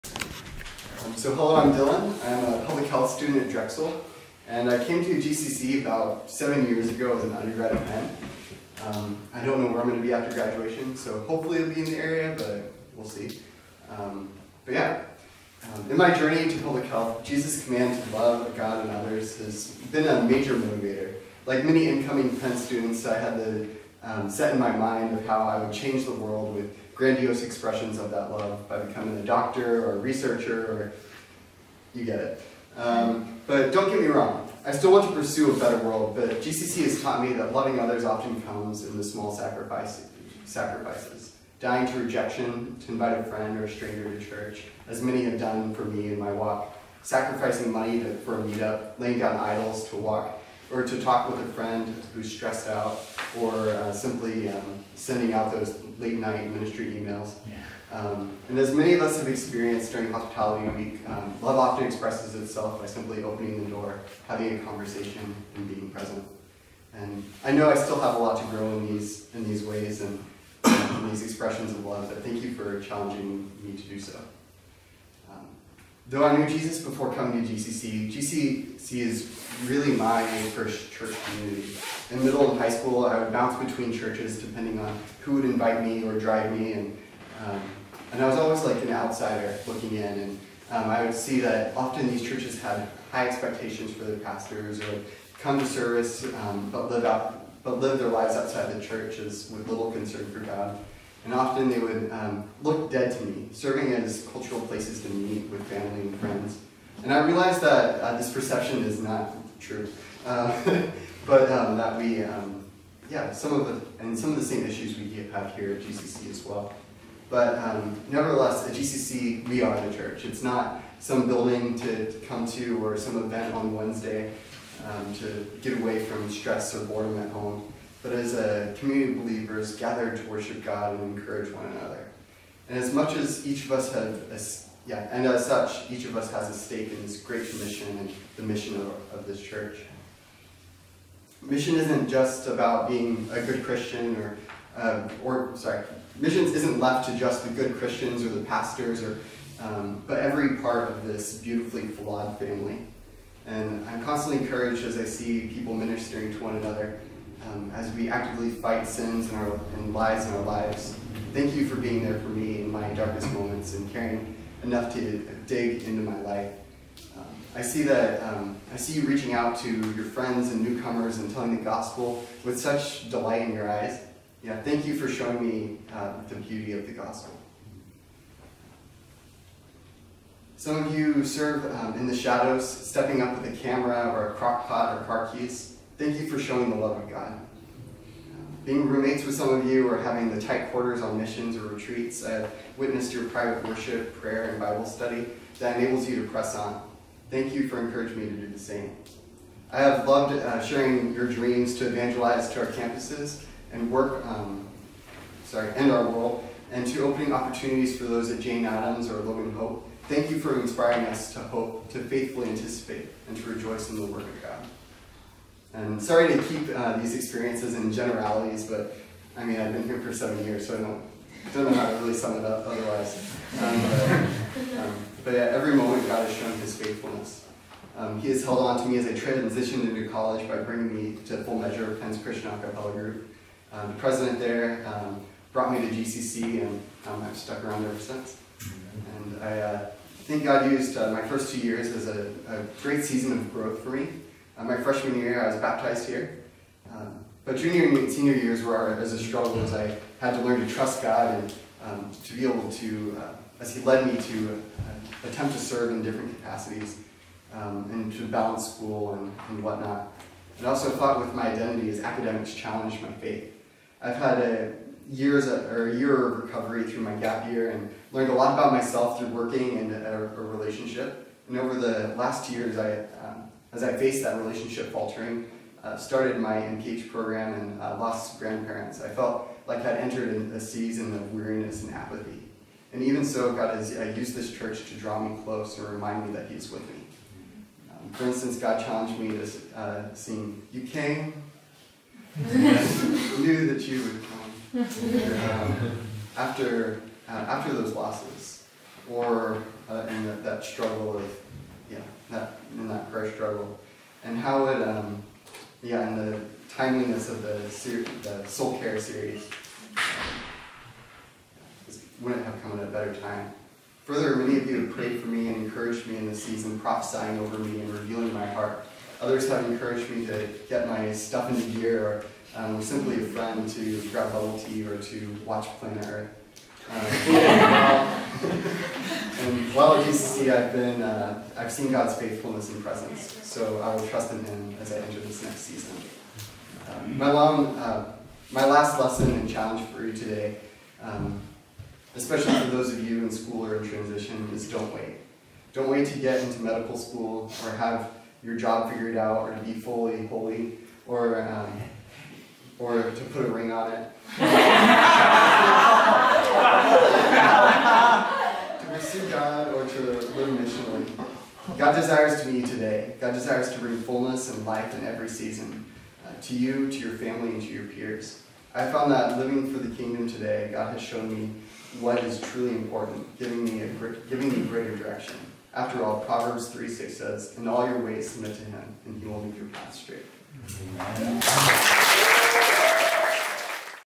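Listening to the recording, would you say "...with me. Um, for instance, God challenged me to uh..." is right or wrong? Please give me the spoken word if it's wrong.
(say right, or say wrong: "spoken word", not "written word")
right.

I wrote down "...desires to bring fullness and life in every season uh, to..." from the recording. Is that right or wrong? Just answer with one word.
right.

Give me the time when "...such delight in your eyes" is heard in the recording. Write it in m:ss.
2:52.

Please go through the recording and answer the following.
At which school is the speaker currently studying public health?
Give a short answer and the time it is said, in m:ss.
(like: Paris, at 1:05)
Drexel, at 0:03.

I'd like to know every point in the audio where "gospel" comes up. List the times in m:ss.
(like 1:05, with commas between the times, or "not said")
2:51, 2:56.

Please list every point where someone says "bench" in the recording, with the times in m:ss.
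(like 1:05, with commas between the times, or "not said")
not said.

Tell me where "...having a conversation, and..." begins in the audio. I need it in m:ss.
1:04.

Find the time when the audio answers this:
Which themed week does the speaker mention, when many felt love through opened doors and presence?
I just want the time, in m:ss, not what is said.
1:00.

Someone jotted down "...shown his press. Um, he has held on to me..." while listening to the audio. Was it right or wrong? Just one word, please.
wrong.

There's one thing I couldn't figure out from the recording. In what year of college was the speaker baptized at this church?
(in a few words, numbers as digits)
Freshman year.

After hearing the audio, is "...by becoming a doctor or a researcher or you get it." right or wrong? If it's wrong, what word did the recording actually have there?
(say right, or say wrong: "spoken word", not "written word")
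right.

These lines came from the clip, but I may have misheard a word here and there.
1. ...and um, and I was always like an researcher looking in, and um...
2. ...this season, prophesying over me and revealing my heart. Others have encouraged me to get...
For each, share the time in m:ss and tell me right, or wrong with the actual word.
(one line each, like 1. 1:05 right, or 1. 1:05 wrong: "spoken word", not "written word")
1. 1:26 wrong: "outsider", not "researcher"
2. 5:16 right.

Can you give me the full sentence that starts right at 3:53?
Um, the president there um, brought me to GCC, and um, I've stuck around ever since.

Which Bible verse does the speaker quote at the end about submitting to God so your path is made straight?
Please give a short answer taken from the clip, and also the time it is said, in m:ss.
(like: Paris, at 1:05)
Proverbs 3:6, at 6:16.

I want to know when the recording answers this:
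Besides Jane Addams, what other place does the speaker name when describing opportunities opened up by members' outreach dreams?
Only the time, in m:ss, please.
3:29.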